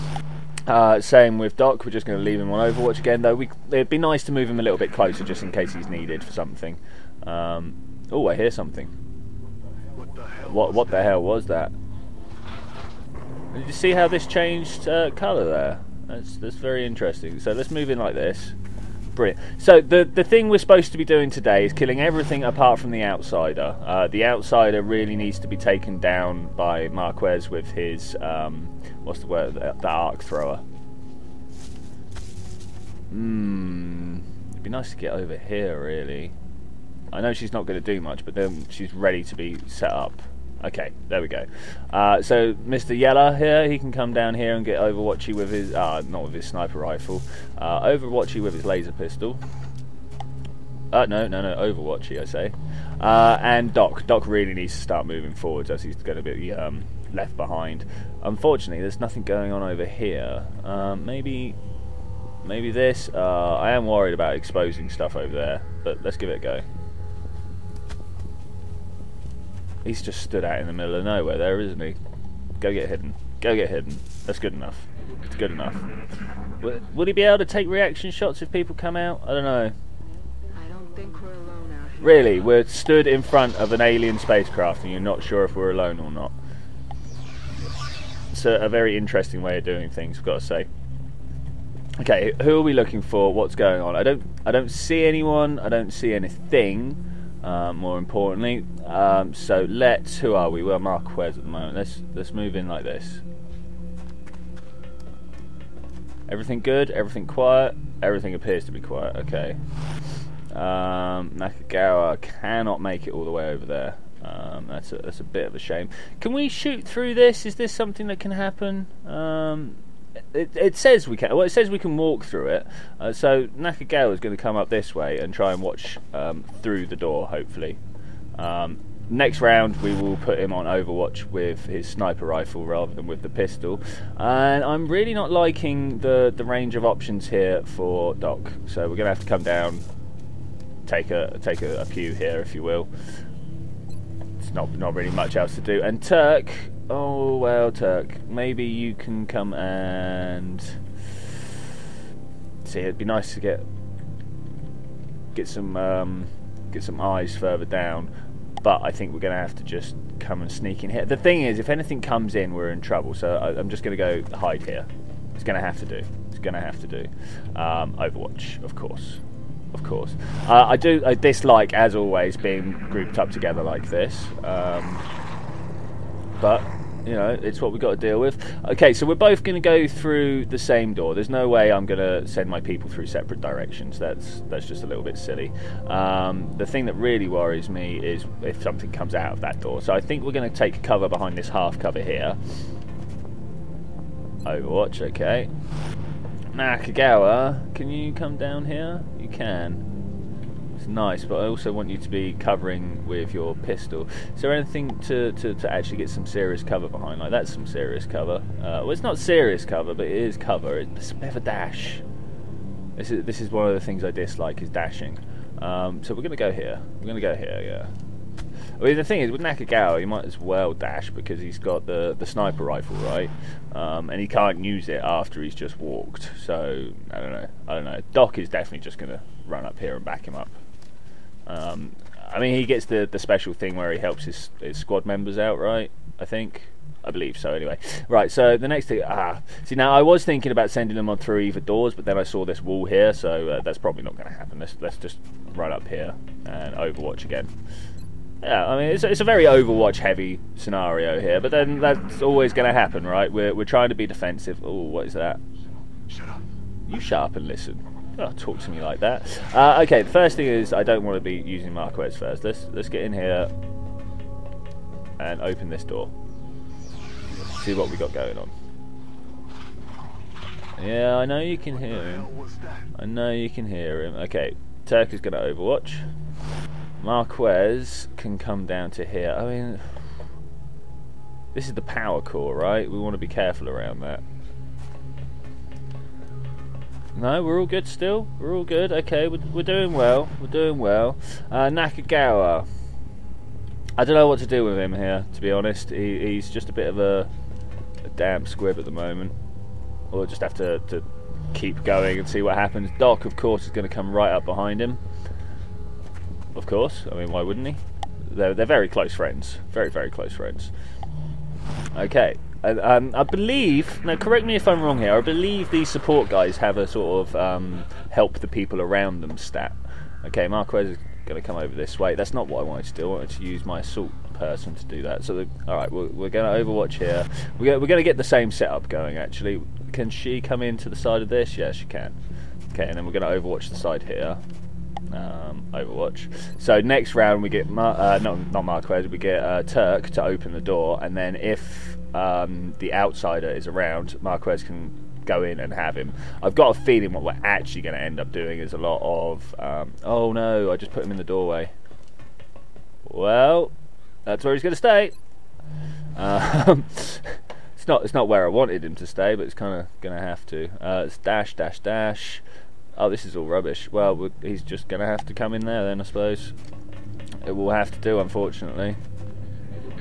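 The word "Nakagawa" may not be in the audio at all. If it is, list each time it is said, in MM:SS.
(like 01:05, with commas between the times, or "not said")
01:51, 02:03, 03:16, 03:39, 04:51.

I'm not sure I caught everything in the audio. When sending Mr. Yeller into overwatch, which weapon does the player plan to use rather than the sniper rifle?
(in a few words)
laser pistol.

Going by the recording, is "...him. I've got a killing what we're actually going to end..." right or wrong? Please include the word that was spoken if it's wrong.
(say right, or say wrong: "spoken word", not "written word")
wrong: "feeling", not "killing".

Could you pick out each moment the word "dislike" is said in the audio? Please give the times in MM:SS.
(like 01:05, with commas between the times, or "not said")
02:51, 03:34.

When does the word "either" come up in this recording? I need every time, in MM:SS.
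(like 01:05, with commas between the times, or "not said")
04:01.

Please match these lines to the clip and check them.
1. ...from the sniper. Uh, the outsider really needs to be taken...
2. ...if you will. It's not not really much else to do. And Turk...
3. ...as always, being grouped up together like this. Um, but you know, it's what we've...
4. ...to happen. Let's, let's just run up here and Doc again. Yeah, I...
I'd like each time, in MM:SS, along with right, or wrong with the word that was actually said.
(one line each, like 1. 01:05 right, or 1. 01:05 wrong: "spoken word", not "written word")
1. 00:22 wrong: "outsider", not "sniper"
2. 02:22 right
3. 02:51 right
4. 04:04 wrong: "Overwatch", not "Doc".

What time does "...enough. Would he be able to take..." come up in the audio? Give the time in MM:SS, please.
01:15.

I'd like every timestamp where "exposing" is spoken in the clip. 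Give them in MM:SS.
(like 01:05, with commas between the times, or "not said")
01:04.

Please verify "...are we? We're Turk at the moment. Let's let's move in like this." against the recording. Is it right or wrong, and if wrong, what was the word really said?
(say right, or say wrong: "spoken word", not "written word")
wrong: "Marquez", not "Turk".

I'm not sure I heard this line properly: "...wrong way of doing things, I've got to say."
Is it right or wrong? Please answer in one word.
wrong.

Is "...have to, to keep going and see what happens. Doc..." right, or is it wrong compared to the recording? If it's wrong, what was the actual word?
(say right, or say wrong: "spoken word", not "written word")
right.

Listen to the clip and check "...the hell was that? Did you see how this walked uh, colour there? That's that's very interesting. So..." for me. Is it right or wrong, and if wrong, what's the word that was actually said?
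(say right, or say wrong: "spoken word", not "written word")
wrong: "changed", not "walked".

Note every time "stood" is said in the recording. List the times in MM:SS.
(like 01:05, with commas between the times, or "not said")
01:10, 01:22.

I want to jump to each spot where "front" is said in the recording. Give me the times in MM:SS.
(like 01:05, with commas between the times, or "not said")
01:23.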